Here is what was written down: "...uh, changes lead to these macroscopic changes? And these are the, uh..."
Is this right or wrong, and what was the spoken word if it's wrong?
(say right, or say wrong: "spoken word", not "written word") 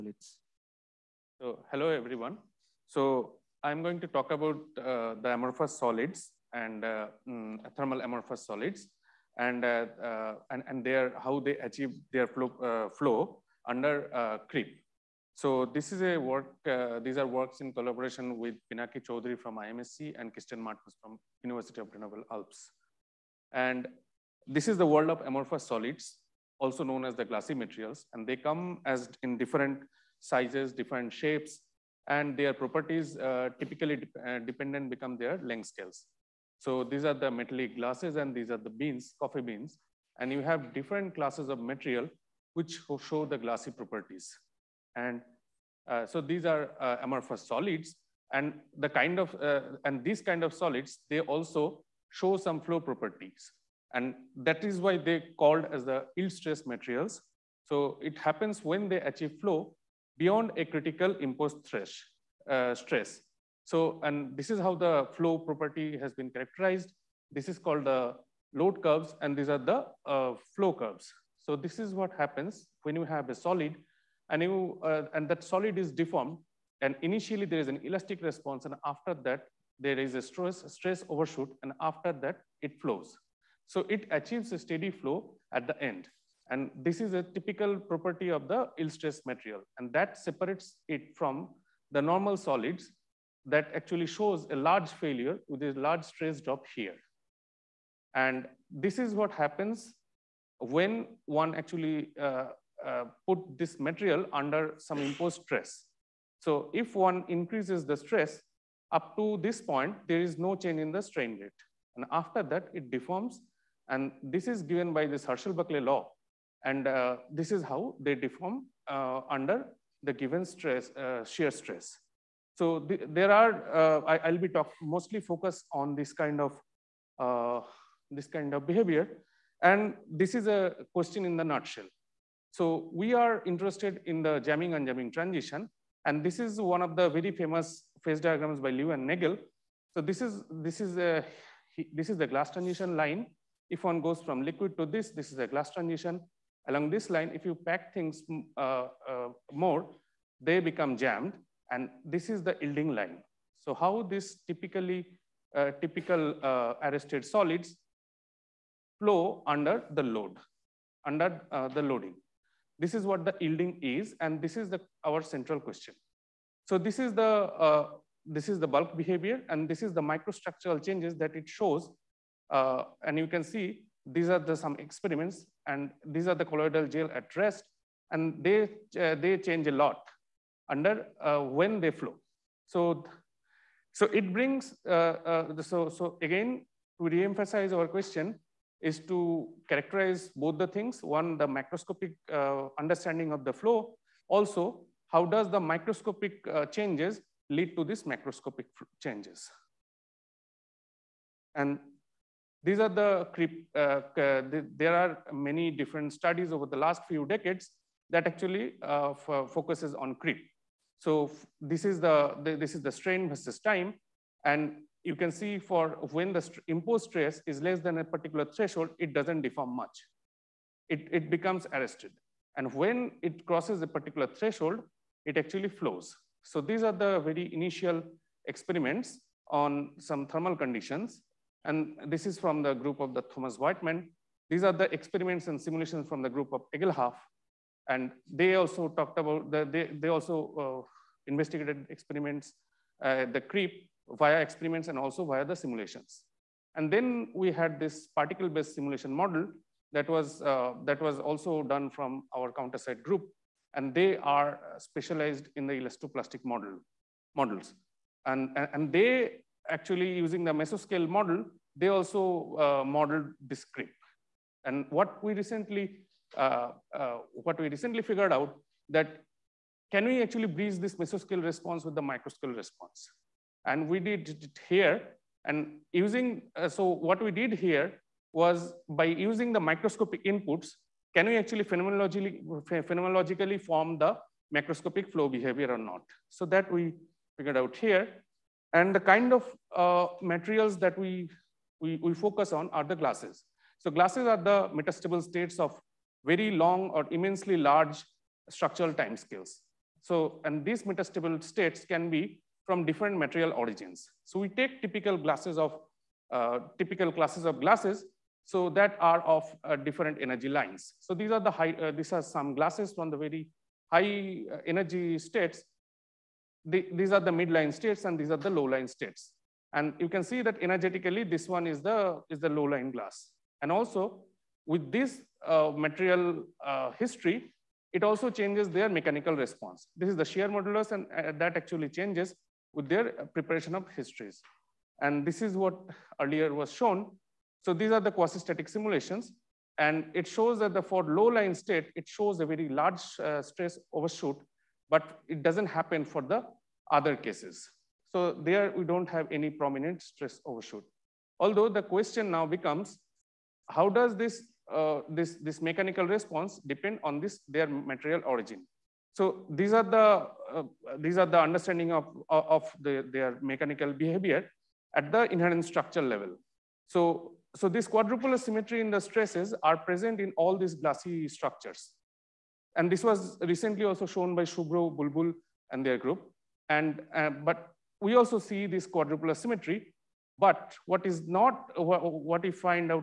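right.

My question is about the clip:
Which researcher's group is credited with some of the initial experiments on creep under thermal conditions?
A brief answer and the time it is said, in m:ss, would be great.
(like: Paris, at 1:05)
Thomas Voigtmann, at 3:53.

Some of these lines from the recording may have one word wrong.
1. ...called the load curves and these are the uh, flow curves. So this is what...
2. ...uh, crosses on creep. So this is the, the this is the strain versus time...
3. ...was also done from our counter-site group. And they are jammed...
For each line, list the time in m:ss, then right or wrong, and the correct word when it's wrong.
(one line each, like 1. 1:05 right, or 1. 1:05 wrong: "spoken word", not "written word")
1. 1:07 right
2. 3:28 wrong: "focuses", not "crosses"
3. 4:11 wrong: "specialized", not "jammed".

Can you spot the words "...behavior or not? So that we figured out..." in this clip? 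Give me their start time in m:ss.
4:45.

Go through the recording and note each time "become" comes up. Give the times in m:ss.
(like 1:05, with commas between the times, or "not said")
0:34, 2:30, 3:41, 5:52.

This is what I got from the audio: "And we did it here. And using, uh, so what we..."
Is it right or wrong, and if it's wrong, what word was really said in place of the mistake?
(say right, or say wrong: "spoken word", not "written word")
right.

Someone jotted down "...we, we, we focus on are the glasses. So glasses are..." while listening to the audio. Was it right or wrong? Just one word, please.
right.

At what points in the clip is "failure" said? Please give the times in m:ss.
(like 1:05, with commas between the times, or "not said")
1:34.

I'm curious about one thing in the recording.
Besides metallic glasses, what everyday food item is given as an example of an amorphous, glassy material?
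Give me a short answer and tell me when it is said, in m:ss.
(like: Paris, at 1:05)
Coffee beans, at 0:39.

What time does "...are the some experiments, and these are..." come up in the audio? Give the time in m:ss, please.
2:54.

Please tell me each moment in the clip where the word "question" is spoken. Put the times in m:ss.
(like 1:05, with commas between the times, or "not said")
2:10, 2:45, 3:07, 5:51.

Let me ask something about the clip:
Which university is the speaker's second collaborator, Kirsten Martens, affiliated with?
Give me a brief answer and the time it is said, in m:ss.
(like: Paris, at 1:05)
University of Grenoble Alps, at 0:21.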